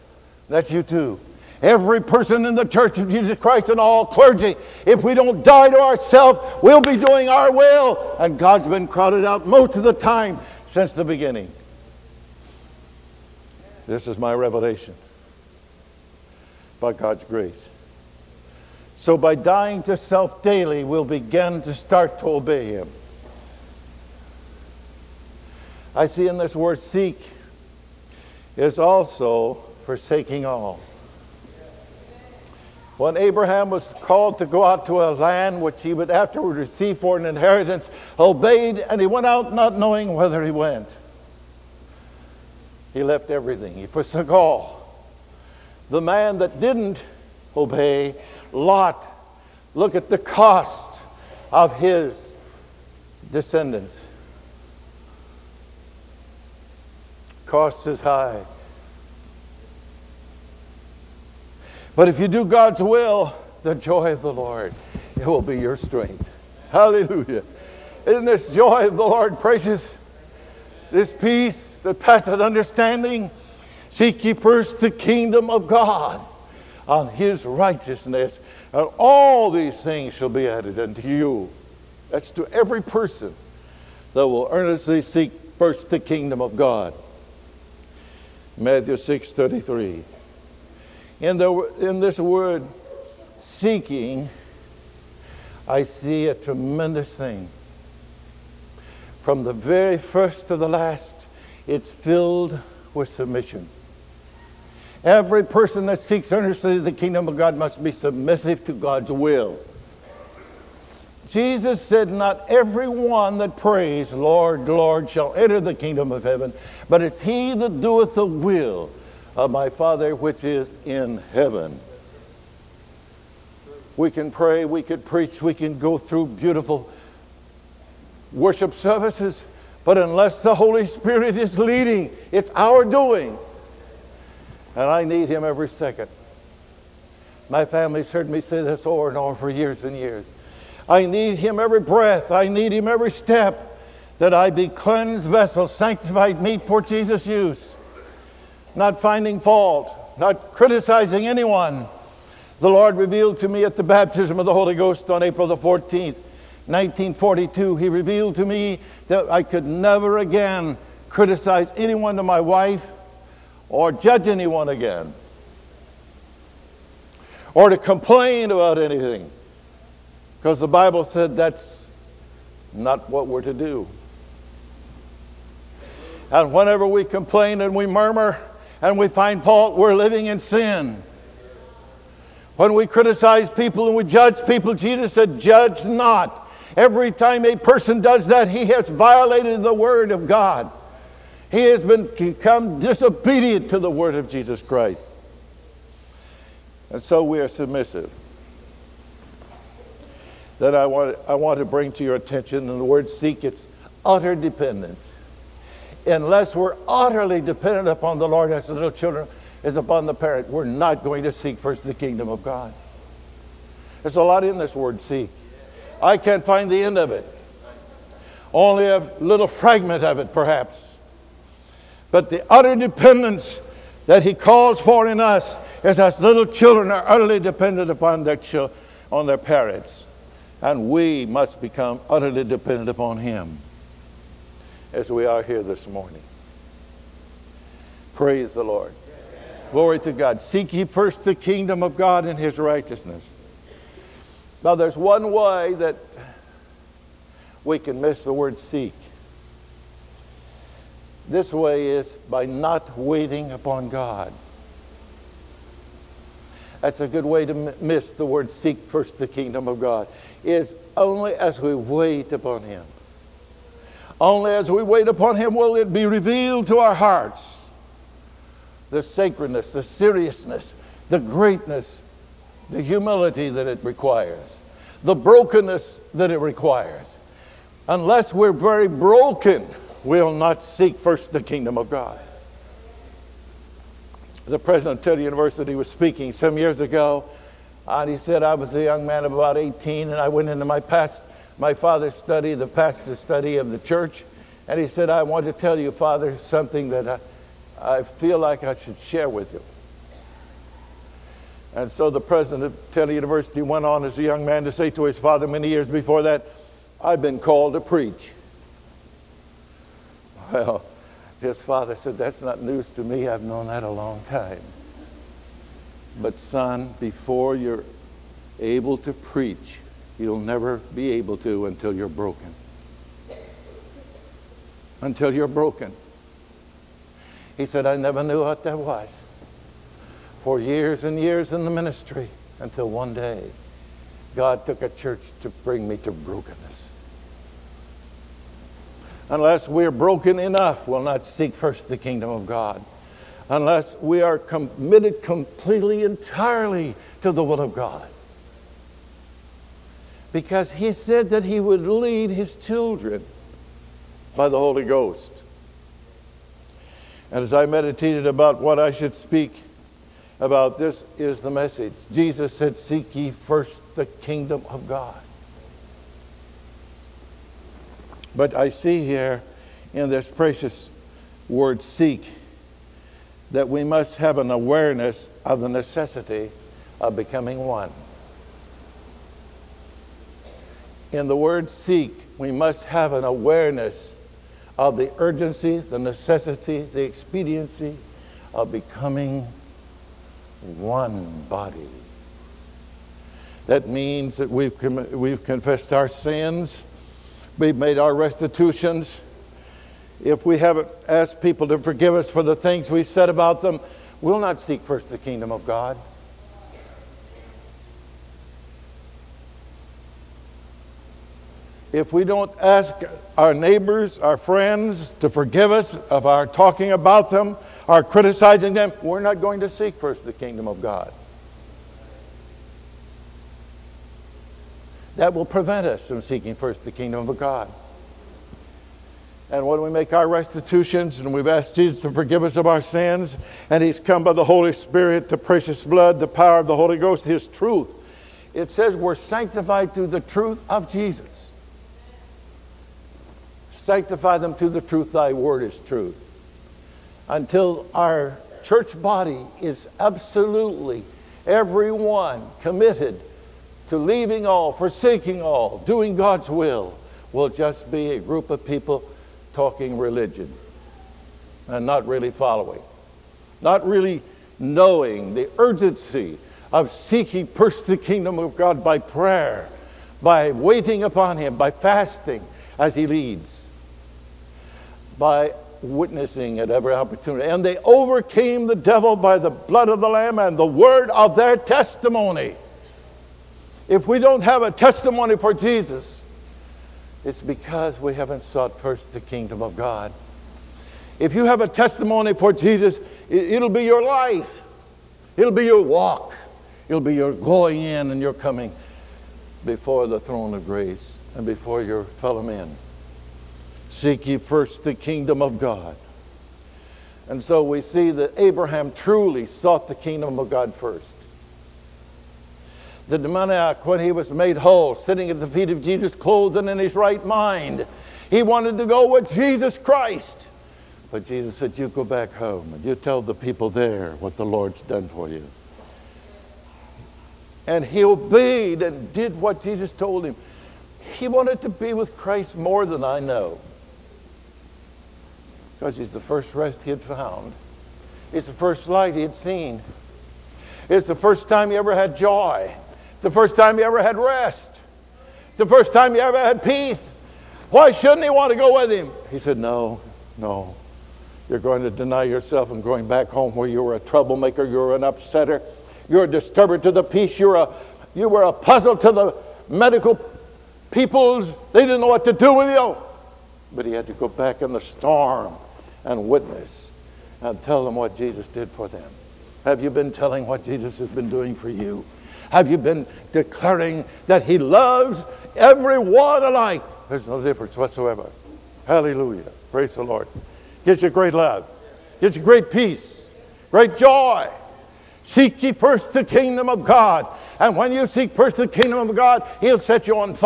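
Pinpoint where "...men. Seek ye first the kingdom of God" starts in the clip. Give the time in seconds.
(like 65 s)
502 s.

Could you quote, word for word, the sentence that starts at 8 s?
And God's been crowded out most of the time since the beginning.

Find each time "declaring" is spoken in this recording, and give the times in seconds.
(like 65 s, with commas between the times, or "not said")
573 s.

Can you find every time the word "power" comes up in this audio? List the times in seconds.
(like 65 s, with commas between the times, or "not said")
436 s.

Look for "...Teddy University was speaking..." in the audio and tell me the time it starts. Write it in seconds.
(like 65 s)
285 s.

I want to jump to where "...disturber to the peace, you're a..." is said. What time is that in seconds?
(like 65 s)
556 s.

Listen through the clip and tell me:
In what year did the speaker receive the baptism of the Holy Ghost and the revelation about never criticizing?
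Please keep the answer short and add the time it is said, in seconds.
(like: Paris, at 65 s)
1942, at 156 s.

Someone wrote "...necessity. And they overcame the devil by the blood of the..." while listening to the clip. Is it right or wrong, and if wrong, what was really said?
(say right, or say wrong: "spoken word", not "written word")
wrong: "opportunity", not "necessity".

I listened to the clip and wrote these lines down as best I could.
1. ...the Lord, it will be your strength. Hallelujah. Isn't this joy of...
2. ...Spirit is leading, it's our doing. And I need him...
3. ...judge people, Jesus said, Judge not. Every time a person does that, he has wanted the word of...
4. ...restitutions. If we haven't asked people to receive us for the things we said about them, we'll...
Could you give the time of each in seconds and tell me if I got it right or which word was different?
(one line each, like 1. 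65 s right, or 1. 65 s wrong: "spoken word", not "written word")
1. 64 s right
2. 130 s right
3. 184 s wrong: "violated", not "wanted"
4. 398 s wrong: "forgive", not "receive".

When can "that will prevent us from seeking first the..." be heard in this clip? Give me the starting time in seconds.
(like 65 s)
425 s.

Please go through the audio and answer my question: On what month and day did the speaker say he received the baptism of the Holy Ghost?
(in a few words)
April 14.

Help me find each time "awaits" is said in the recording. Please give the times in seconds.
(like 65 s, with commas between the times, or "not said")
not said.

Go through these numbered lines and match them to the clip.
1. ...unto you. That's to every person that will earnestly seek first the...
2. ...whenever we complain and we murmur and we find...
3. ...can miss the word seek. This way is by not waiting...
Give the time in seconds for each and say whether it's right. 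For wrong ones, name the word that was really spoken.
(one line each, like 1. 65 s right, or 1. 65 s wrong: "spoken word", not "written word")
1. 80 s right
2. 176 s right
3. 247 s right.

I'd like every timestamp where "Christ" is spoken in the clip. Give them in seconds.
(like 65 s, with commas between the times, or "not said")
3 s, 194 s, 519 s, 532 s.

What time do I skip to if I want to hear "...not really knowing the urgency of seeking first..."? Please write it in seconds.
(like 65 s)
463 s.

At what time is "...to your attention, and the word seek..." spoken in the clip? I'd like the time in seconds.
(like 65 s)
201 s.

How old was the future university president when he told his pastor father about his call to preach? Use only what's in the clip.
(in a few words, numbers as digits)
18.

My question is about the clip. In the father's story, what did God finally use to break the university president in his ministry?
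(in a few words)
a church.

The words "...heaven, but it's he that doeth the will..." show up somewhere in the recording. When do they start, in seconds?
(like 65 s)
116 s.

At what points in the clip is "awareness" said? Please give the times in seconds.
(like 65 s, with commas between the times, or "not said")
374 s, 383 s.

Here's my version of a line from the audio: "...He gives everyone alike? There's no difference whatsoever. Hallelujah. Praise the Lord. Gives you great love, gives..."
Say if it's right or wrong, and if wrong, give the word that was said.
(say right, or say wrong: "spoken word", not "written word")
wrong: "loves", not "gives".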